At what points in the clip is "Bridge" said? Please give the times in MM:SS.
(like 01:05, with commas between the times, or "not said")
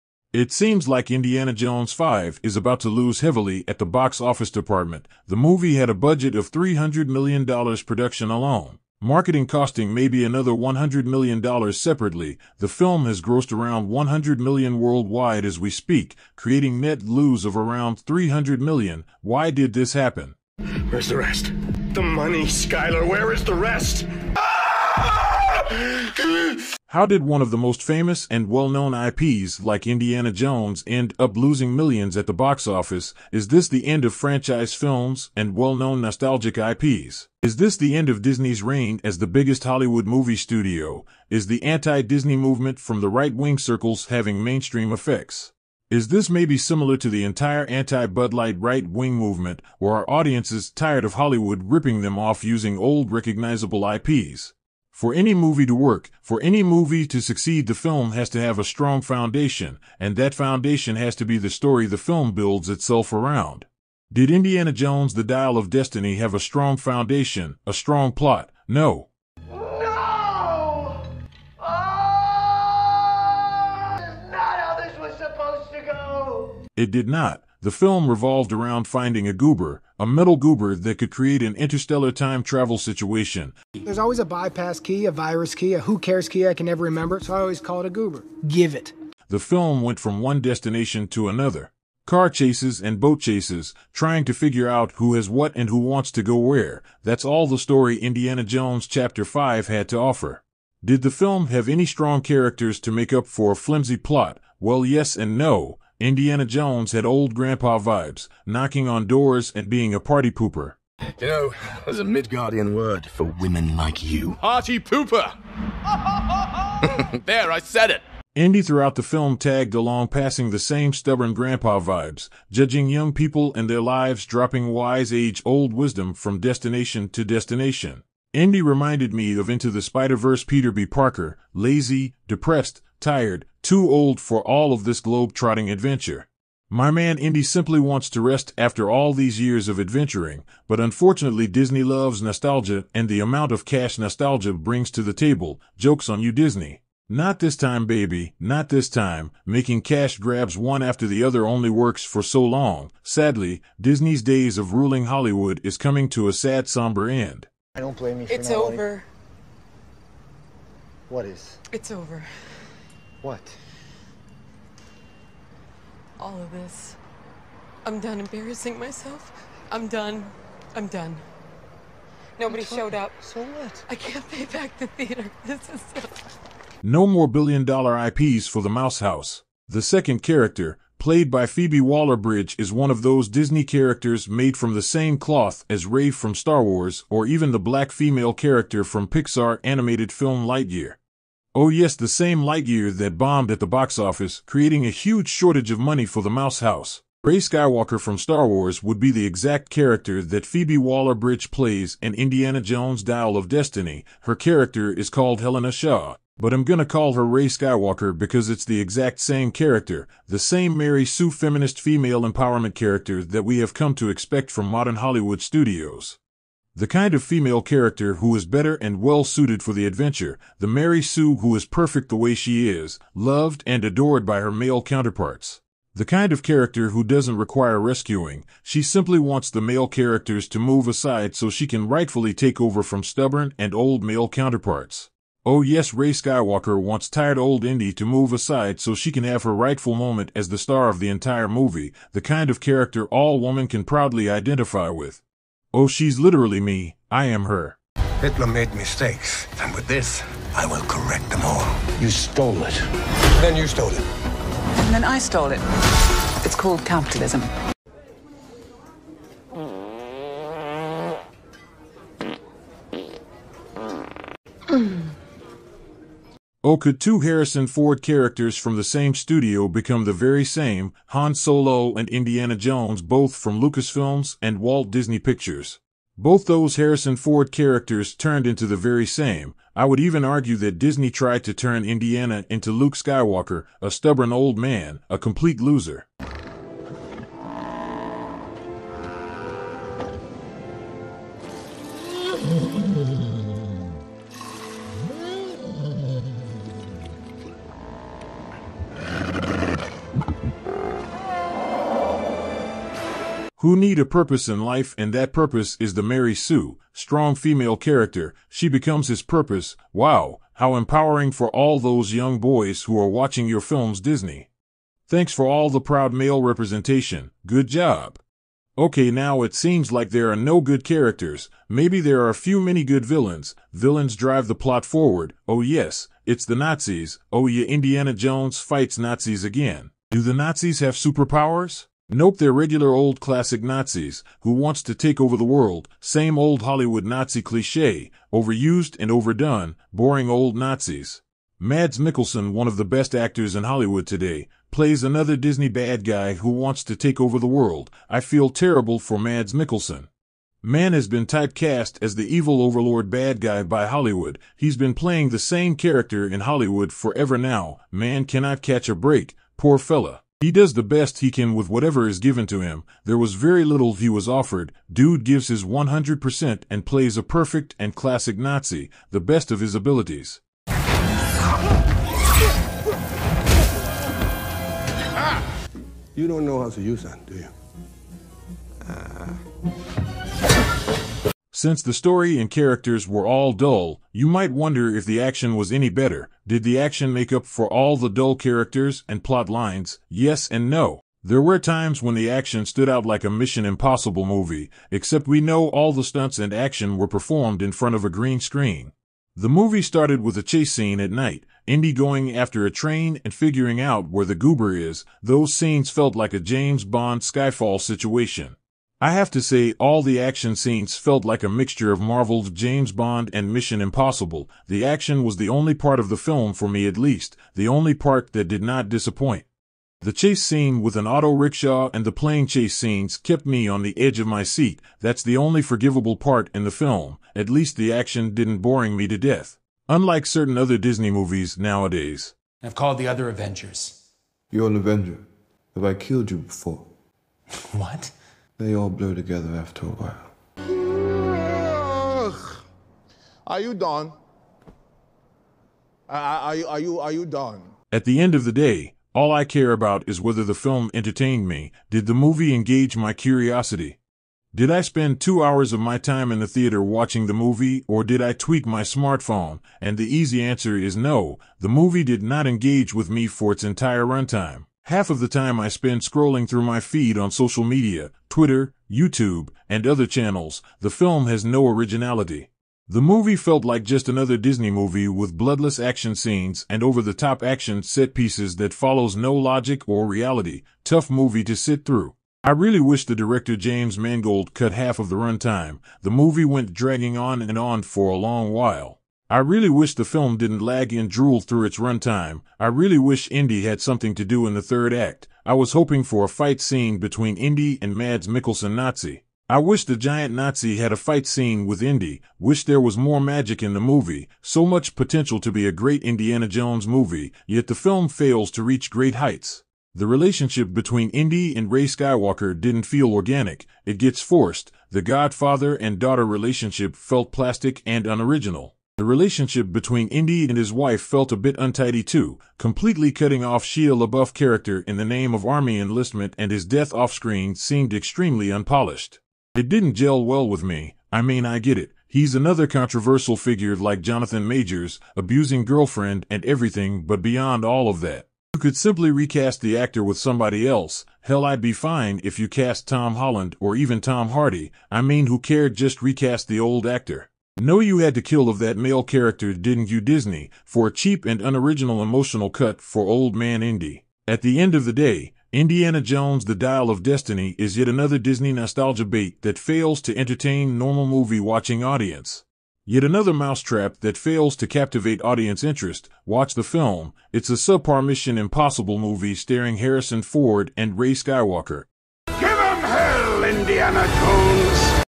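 03:01, 03:20.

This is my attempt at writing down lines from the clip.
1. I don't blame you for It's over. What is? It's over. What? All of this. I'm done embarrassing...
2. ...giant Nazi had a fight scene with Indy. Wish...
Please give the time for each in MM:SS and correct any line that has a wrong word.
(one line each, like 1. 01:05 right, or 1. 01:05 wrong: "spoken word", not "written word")
1. 02:37 right
2. 08:19 right.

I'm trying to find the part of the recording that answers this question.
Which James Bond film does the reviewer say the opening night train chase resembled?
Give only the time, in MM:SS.
06:47.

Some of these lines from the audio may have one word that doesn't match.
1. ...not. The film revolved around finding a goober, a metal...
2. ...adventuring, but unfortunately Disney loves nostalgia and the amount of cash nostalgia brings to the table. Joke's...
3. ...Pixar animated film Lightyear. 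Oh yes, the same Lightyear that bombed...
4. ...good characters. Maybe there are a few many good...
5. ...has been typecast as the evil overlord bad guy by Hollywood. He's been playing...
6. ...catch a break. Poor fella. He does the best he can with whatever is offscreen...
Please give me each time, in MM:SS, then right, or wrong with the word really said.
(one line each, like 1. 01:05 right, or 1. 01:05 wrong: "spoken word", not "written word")
1. 01:17 right
2. 02:19 right
3. 03:09 right
4. 05:20 right
5. 05:50 right
6. 05:58 wrong: "given", not "offscreen".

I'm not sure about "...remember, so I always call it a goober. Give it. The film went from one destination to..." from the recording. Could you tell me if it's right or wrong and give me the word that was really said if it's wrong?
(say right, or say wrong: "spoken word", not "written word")
right.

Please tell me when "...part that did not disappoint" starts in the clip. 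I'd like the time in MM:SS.
06:57.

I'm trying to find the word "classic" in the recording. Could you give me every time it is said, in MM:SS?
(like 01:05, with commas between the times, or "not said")
05:33, 06:07.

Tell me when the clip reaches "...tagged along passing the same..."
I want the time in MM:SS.
01:59.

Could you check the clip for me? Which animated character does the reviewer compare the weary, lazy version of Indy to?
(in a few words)
Peter B. Parker.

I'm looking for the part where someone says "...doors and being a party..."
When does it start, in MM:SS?
01:49.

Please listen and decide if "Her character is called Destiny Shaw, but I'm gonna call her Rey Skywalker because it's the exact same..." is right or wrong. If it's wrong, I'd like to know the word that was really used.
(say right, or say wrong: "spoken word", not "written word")
wrong: "Helena", not "Destiny".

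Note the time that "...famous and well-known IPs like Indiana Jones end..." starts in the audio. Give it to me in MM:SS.
00:27.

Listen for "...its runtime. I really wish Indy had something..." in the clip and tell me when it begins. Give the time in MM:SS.
08:11.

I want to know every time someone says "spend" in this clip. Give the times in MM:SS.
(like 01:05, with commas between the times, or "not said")
07:34, 07:45.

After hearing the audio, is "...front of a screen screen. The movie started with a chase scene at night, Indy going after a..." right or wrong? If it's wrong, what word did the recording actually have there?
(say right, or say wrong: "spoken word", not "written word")
wrong: "green", not "screen".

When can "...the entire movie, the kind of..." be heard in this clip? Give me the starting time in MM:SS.
04:00.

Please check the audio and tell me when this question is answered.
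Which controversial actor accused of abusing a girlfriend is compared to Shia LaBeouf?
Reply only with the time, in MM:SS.
08:54.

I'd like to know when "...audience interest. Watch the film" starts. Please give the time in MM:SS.
09:25.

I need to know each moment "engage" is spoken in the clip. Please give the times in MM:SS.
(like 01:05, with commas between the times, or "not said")
07:32, 07:42.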